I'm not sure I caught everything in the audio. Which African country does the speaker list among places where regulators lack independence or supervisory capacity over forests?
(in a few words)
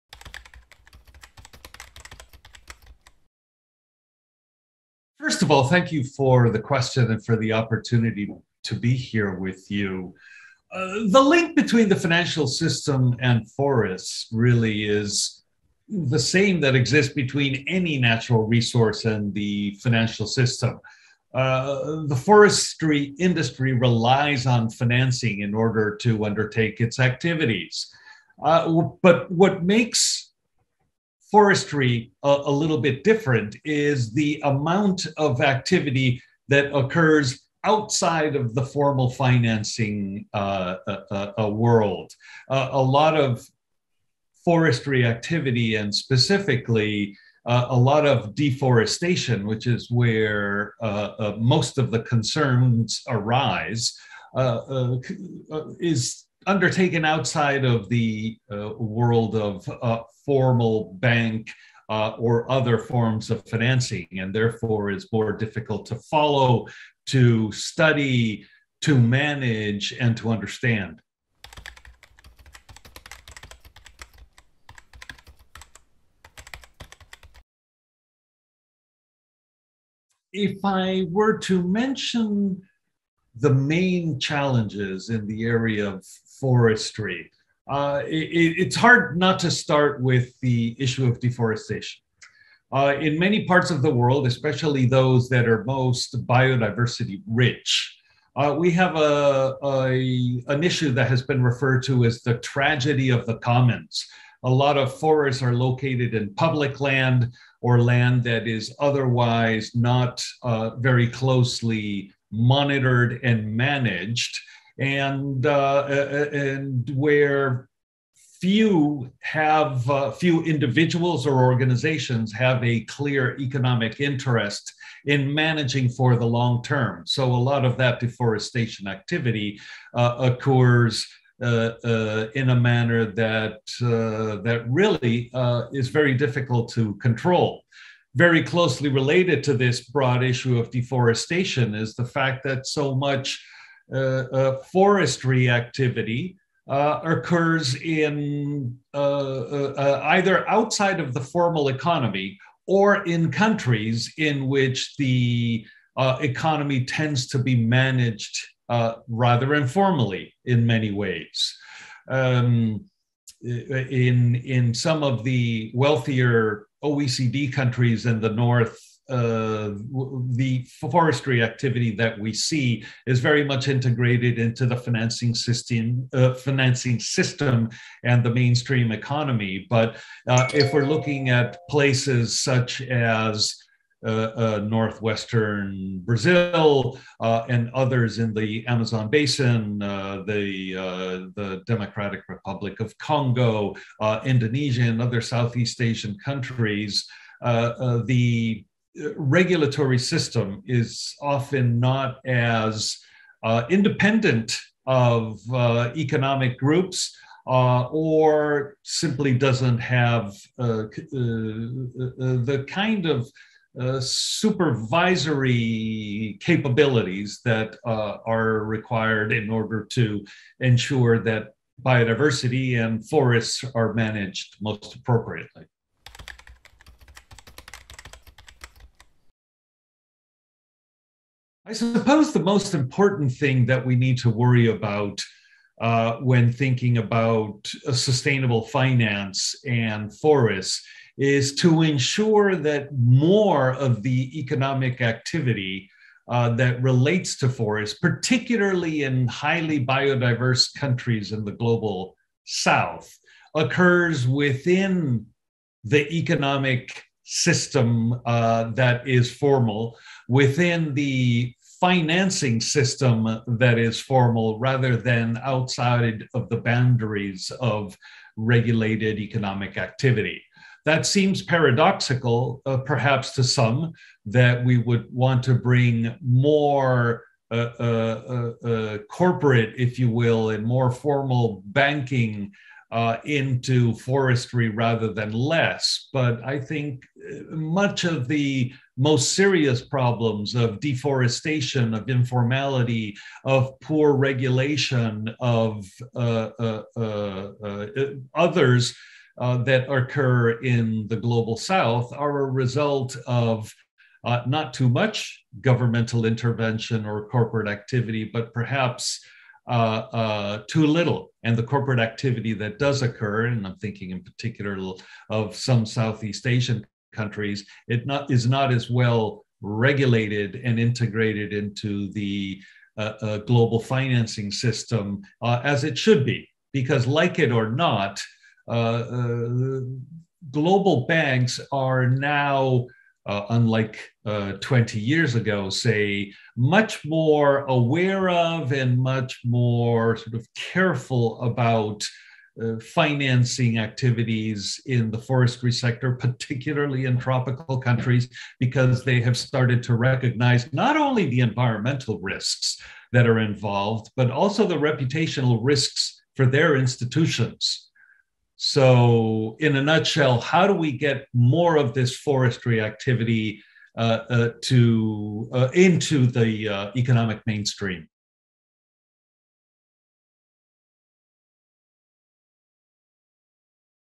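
Democratic Republic of Congo.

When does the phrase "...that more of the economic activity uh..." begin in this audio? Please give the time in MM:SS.
04:02.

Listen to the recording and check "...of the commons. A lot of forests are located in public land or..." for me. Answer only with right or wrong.
right.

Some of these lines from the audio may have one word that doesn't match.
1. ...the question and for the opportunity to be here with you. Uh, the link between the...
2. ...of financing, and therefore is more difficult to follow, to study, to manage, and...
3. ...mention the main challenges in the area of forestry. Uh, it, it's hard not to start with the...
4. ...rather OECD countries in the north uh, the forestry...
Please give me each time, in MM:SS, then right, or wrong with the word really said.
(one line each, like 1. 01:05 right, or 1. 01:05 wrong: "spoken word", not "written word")
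1. 00:06 right
2. 01:03 right
3. 01:21 right
4. 02:45 wrong: "wealthier", not "rather".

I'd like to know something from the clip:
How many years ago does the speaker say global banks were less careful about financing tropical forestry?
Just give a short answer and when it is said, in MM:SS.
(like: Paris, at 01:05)
20 years, at 05:34.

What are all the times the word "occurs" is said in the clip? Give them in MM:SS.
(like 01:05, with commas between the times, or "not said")
00:36, 02:10, 02:27, 04:13, 04:59, 05:13.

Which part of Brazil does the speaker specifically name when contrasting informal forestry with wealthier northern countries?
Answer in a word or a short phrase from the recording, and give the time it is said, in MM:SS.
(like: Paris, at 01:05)
northwestern Brazil, at 03:04.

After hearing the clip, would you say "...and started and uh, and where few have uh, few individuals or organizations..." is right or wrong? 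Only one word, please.
wrong.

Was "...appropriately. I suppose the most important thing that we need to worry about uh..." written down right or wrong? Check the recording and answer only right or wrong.
right.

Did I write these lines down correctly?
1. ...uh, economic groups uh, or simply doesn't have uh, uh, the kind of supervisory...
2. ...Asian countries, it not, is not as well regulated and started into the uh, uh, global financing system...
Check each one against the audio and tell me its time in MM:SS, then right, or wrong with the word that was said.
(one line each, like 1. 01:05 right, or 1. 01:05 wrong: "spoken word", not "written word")
1. 03:25 right
2. 05:16 wrong: "integrated", not "started".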